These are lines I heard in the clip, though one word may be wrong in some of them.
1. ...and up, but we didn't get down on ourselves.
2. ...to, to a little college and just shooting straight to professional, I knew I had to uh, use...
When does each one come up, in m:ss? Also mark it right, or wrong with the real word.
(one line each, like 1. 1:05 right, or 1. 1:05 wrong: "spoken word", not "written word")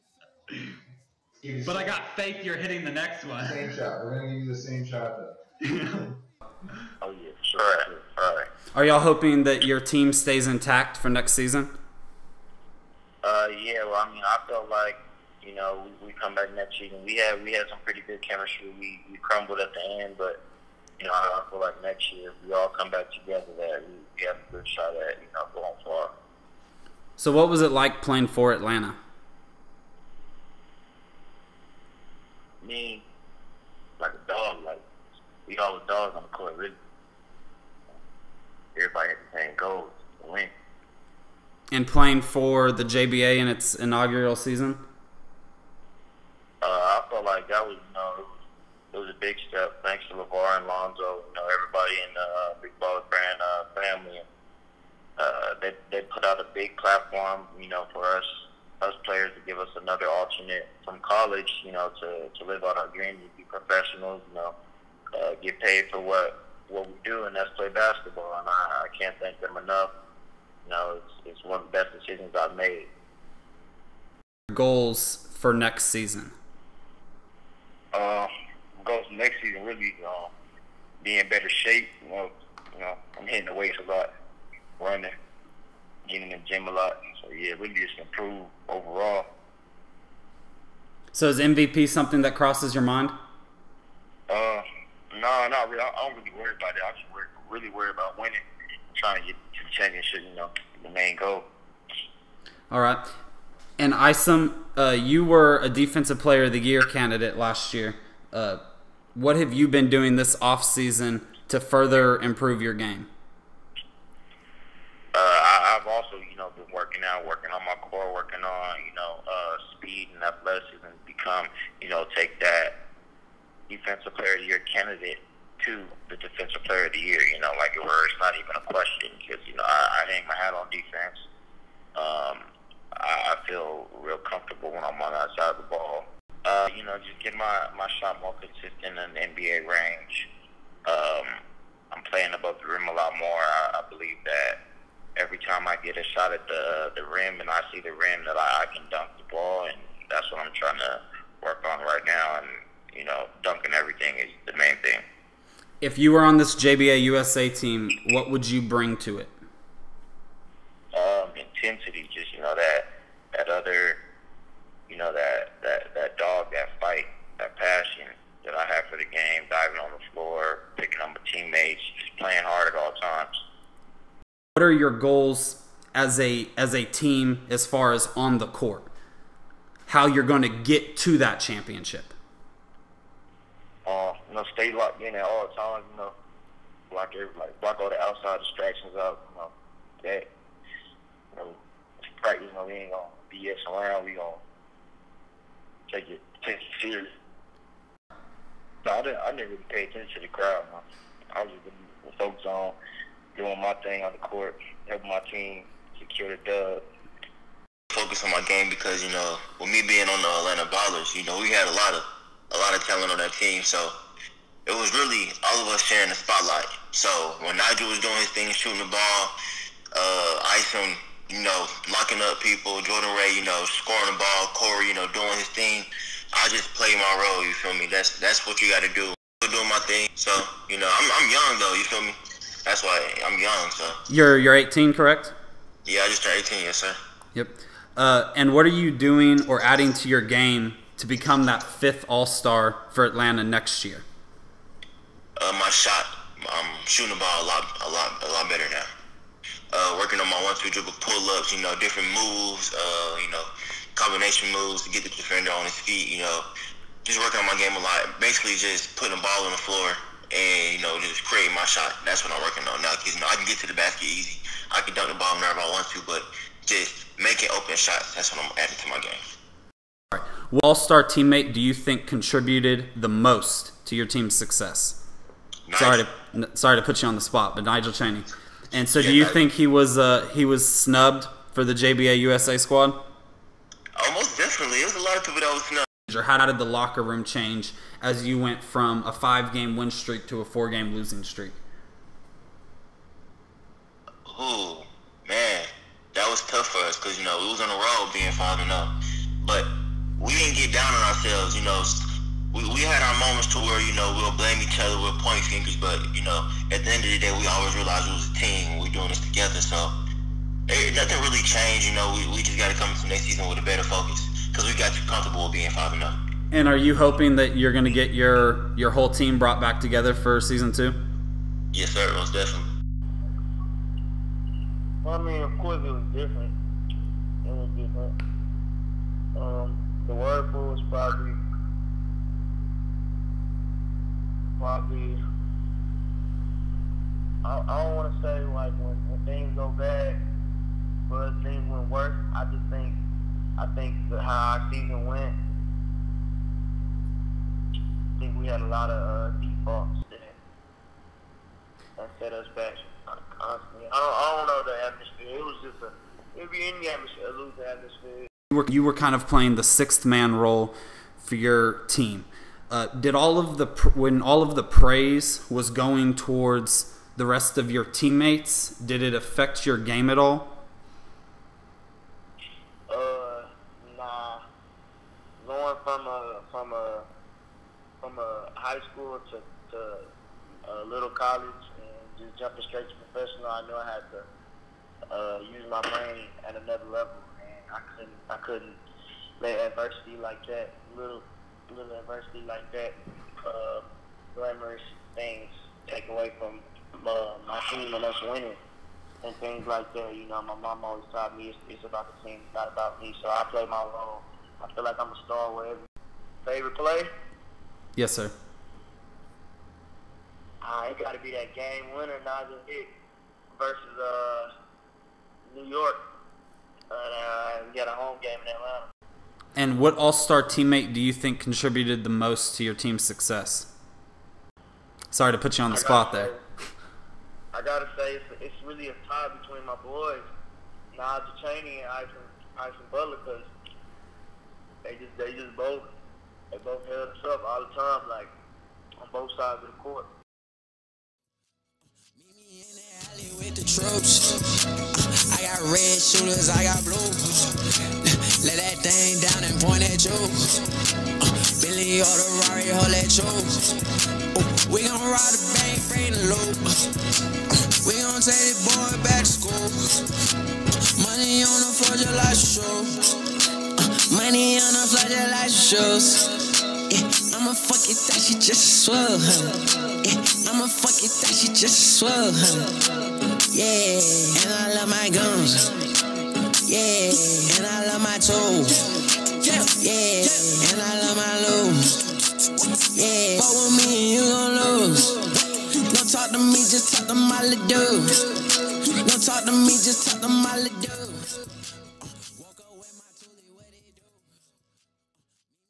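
1. 4:58 right
2. 6:19 wrong: "jumping", not "shooting".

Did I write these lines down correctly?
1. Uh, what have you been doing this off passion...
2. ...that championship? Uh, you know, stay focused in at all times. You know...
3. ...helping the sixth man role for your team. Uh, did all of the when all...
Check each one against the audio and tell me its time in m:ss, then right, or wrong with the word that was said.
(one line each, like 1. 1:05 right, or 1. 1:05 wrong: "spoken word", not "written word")
1. 1:48 wrong: "season", not "passion"
2. 3:01 wrong: "locked", not "focused"
3. 5:59 wrong: "playing", not "helping".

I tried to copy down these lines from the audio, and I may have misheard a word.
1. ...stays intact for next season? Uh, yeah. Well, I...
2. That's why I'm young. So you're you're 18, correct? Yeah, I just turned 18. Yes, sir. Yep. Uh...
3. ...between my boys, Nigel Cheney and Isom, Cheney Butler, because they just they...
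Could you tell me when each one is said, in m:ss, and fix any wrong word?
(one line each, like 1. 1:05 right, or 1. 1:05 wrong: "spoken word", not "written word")
1. 0:10 right
2. 3:52 right
3. 7:09 wrong: "Isom", not "Cheney".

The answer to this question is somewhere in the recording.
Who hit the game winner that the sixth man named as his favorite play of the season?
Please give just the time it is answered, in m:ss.
6:52.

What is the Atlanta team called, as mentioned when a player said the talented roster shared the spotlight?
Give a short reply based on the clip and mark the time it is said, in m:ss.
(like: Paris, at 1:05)
Atlanta Ballers, at 3:30.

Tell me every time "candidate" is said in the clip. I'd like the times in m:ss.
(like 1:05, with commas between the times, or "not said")
1:46, 2:04.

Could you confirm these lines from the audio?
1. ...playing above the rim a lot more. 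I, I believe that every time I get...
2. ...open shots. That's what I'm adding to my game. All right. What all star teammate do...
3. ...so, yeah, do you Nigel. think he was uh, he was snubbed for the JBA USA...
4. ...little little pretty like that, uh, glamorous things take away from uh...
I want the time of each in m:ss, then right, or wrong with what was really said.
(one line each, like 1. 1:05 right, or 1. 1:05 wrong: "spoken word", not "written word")
1. 2:22 right
2. 4:27 right
3. 4:38 right
4. 6:30 wrong: "adversity", not "pretty".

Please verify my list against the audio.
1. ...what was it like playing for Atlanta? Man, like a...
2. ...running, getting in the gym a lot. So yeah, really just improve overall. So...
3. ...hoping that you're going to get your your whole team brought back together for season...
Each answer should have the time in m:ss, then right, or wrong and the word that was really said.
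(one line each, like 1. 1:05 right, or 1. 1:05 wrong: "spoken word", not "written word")
1. 0:27 right
2. 1:24 right
3. 5:16 right.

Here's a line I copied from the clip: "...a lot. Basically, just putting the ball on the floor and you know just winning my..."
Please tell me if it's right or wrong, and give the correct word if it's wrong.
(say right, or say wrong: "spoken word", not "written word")
wrong: "creating", not "winning".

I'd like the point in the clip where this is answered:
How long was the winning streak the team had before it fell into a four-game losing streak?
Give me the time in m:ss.
4:49.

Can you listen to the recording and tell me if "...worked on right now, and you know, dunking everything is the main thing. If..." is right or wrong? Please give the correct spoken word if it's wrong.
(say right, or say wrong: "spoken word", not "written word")
right.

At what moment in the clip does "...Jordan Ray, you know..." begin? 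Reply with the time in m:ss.
3:42.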